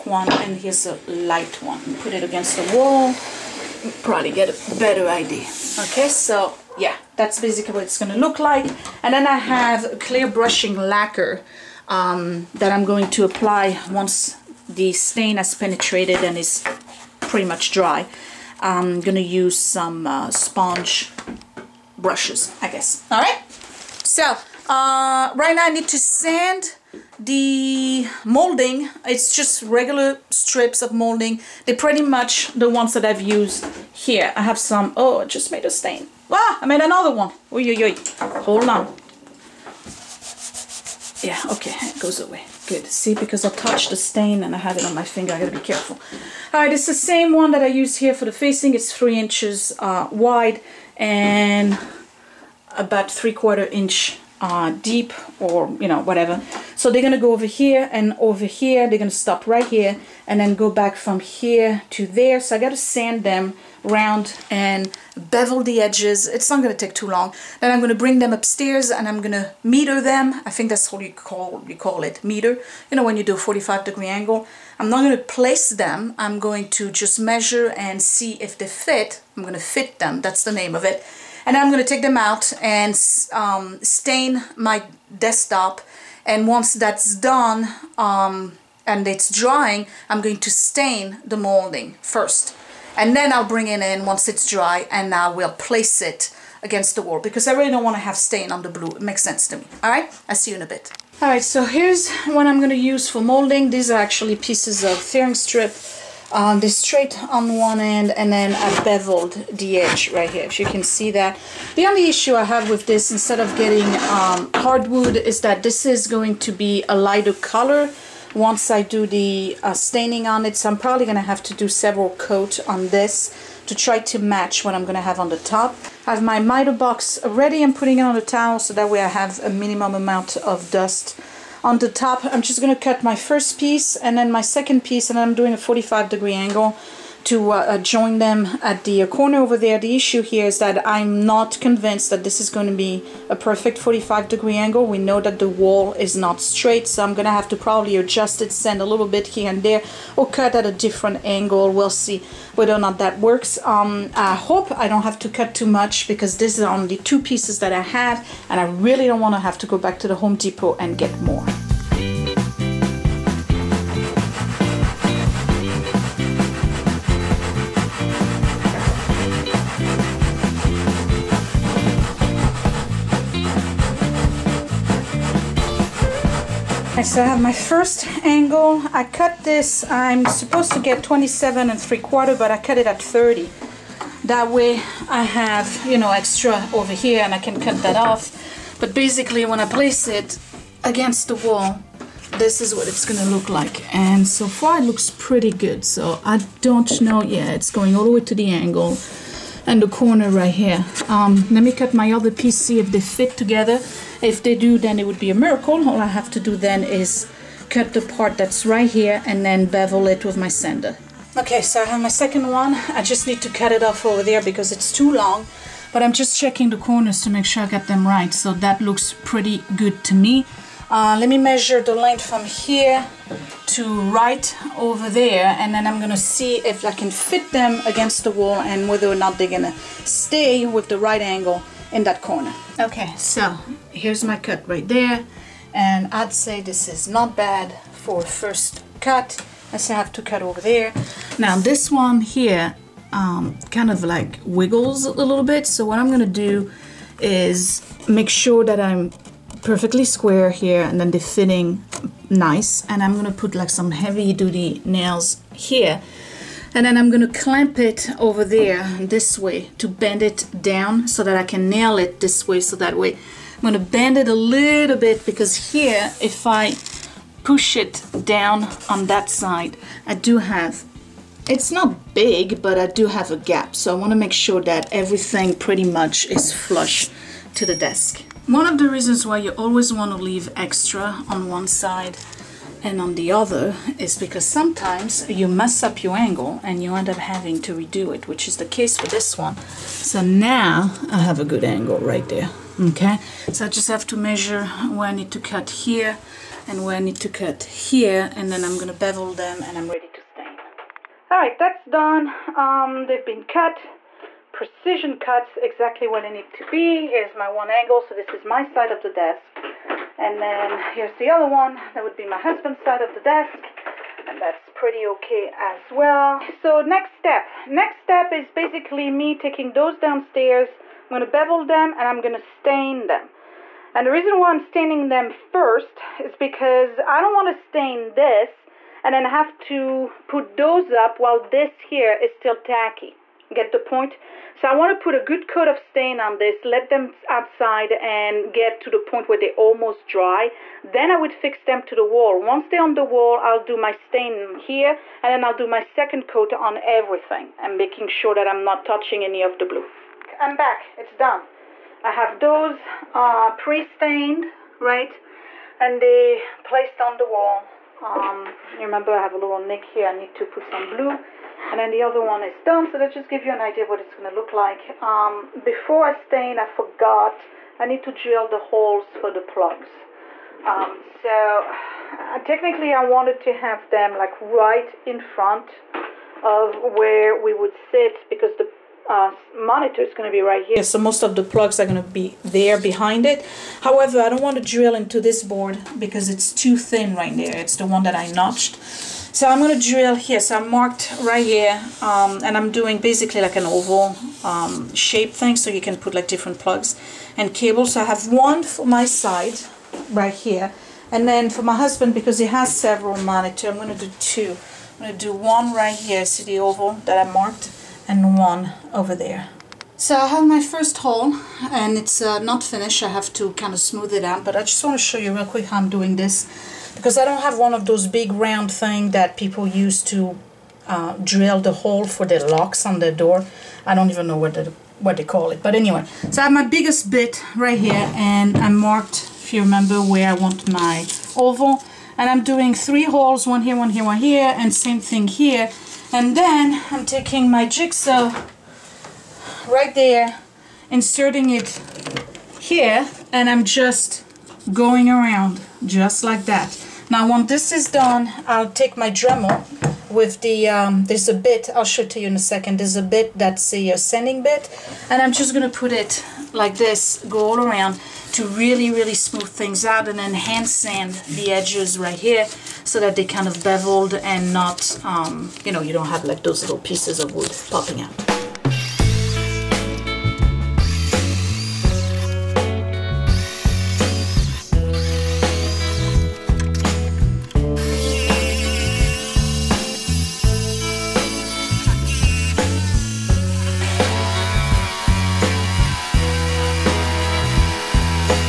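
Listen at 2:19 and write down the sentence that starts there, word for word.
The issue here is that I'm not convinced that this is going to be a perfect 45 degree angle.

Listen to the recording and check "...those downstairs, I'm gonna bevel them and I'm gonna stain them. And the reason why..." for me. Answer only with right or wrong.
right.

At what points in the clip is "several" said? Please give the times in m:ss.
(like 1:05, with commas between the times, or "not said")
2:01, 6:42.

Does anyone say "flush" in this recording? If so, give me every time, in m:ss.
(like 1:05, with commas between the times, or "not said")
4:36.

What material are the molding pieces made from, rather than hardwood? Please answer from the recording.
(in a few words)
furring strip.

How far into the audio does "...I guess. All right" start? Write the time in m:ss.
0:22.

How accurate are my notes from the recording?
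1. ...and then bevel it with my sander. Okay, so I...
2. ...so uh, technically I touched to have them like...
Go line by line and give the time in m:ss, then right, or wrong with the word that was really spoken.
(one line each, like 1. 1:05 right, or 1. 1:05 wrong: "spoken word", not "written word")
1. 3:29 right
2. 6:11 wrong: "wanted", not "touched".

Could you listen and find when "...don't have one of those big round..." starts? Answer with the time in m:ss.
6:57.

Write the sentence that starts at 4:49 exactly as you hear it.
So now I have a good angle right there, okay?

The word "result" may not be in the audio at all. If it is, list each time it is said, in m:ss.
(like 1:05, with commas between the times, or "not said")
not said.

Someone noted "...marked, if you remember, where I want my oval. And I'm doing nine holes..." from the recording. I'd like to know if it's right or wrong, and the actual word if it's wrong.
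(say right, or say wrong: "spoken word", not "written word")
wrong: "three", not "nine".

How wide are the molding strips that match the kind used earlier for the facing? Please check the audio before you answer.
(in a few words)
3 inches.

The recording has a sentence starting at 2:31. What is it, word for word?
We'll see whether or not that works.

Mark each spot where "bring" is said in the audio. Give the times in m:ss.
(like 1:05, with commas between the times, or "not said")
1:08, 1:33.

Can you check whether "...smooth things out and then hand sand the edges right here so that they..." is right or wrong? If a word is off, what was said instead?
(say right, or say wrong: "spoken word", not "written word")
right.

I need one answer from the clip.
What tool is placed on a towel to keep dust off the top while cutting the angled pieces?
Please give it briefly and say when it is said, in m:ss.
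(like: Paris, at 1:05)
miter box, at 2:06.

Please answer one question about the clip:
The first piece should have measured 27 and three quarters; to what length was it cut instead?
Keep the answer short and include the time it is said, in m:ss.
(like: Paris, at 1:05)
30, at 3:02.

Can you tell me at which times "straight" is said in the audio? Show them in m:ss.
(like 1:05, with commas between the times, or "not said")
1:46, 2:26.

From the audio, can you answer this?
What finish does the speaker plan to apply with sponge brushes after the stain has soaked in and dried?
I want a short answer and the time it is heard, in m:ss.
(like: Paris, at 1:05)
clear brushing lacquer, at 0:09.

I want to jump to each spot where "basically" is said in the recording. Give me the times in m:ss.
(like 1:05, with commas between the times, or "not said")
0:07, 3:08, 5:18, 6:32.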